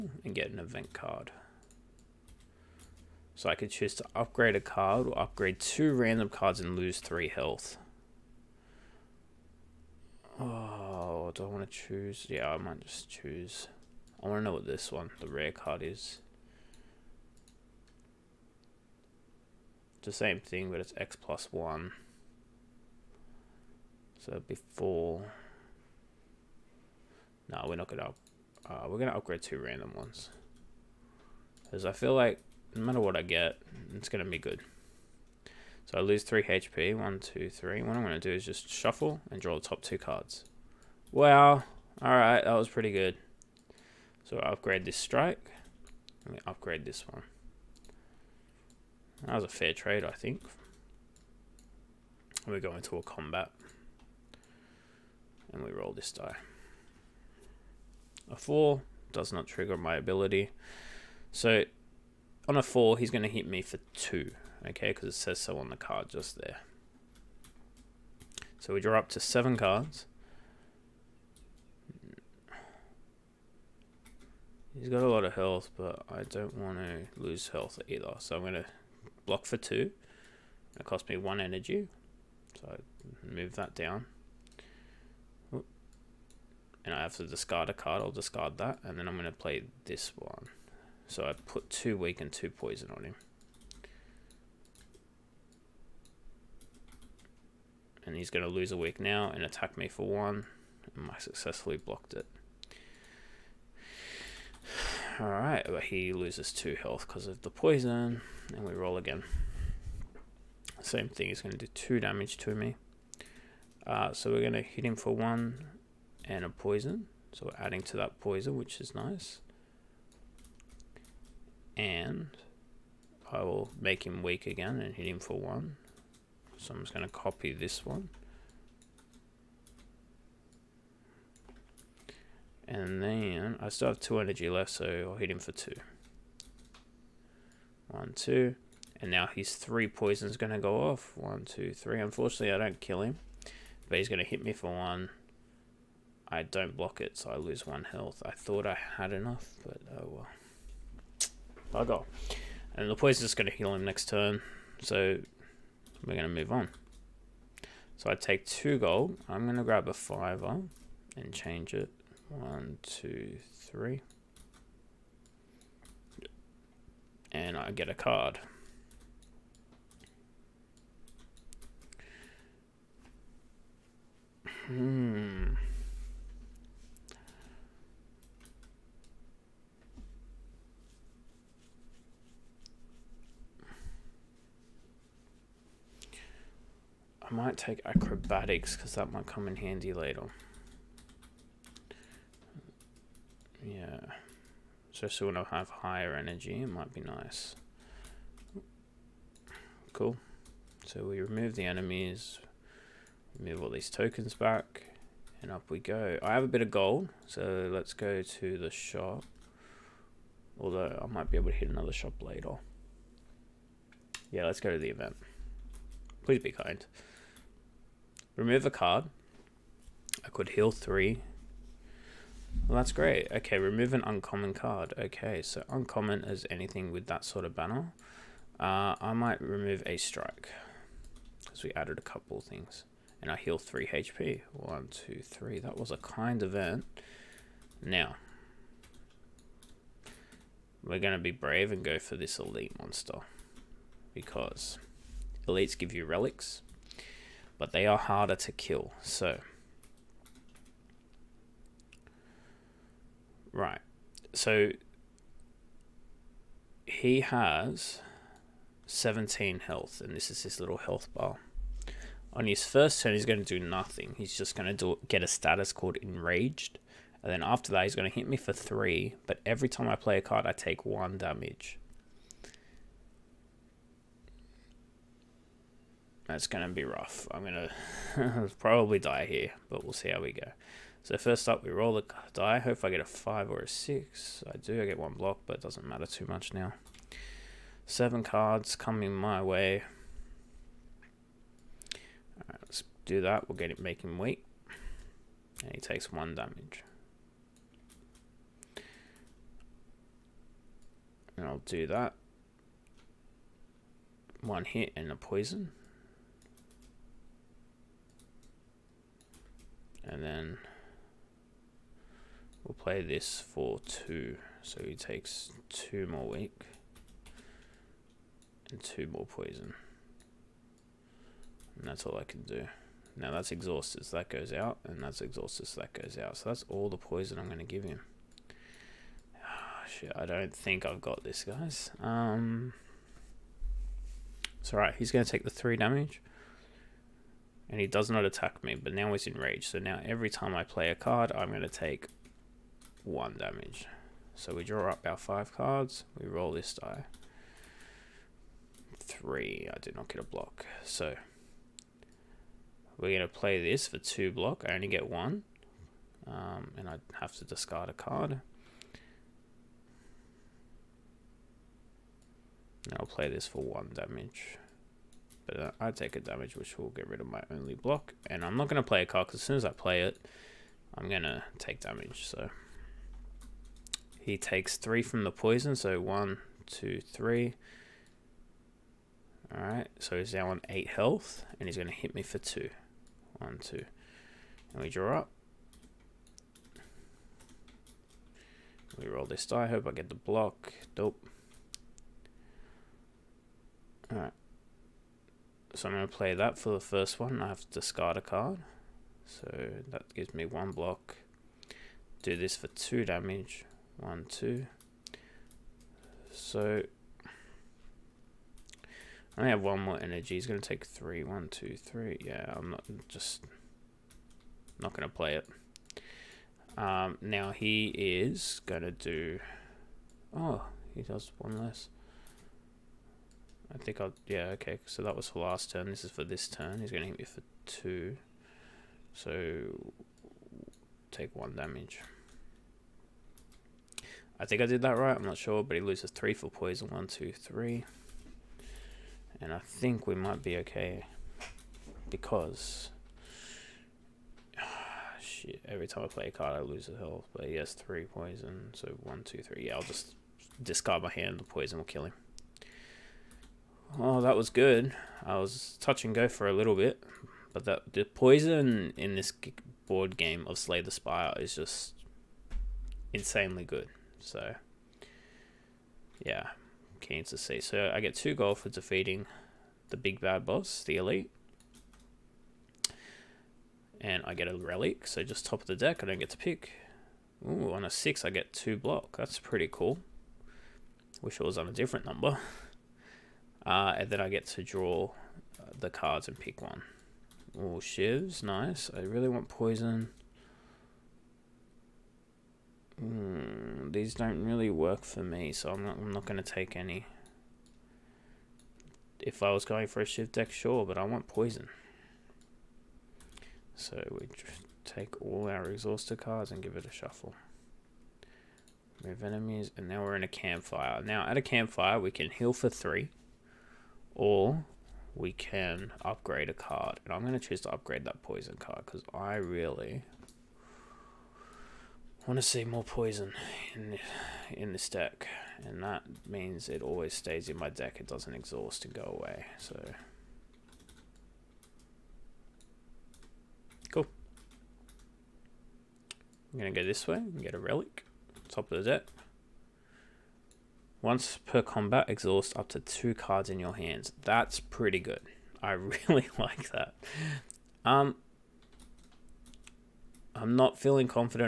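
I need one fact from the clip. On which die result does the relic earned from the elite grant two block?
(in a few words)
6.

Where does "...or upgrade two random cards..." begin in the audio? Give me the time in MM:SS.
00:05.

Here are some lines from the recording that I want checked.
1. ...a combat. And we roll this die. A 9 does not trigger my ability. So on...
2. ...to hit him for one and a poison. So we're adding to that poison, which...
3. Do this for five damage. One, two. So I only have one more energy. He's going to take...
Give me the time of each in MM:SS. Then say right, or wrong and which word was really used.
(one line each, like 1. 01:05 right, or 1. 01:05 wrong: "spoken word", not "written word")
1. 00:52 wrong: "4", not "9"
2. 01:54 right
3. 06:42 wrong: "two", not "five".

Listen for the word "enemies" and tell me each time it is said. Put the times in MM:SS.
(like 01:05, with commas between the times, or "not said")
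03:21, 08:29.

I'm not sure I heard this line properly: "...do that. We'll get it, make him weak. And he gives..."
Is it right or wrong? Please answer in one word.
wrong.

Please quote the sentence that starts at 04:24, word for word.
He's just going to do, get a status called Enraged.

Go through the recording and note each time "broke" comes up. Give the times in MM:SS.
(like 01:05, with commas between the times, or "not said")
not said.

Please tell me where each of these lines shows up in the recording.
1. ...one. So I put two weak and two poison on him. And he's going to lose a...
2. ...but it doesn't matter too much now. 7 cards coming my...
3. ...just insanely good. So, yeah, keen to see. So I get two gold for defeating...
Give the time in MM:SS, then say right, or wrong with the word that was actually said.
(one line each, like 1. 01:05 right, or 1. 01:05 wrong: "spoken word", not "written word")
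1. 01:30 right
2. 04:45 right
3. 07:41 right.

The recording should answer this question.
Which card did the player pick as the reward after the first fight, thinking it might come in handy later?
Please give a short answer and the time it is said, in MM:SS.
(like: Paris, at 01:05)
Acrobatics, at 03:07.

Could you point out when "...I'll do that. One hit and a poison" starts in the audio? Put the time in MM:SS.
05:01.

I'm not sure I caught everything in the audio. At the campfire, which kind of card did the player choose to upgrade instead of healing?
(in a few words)
Poison card.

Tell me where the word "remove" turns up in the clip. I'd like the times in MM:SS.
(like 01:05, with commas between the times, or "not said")
03:21, 03:38, 03:43, 03:49.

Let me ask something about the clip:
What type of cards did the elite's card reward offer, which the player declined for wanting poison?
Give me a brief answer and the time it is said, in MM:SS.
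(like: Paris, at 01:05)
Shivs, at 08:07.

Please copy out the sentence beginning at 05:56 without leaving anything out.
Um, and I have to discard a card.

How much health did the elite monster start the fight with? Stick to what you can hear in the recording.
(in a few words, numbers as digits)
17.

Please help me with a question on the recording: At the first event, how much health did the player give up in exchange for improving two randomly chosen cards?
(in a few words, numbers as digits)
3.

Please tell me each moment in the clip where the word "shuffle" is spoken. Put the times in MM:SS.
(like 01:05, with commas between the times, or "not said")
00:38, 08:26.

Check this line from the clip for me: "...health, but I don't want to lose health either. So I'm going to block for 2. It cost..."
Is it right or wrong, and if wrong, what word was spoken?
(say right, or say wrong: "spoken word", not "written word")
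right.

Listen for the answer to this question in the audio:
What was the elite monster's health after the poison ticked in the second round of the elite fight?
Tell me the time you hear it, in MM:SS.
06:20.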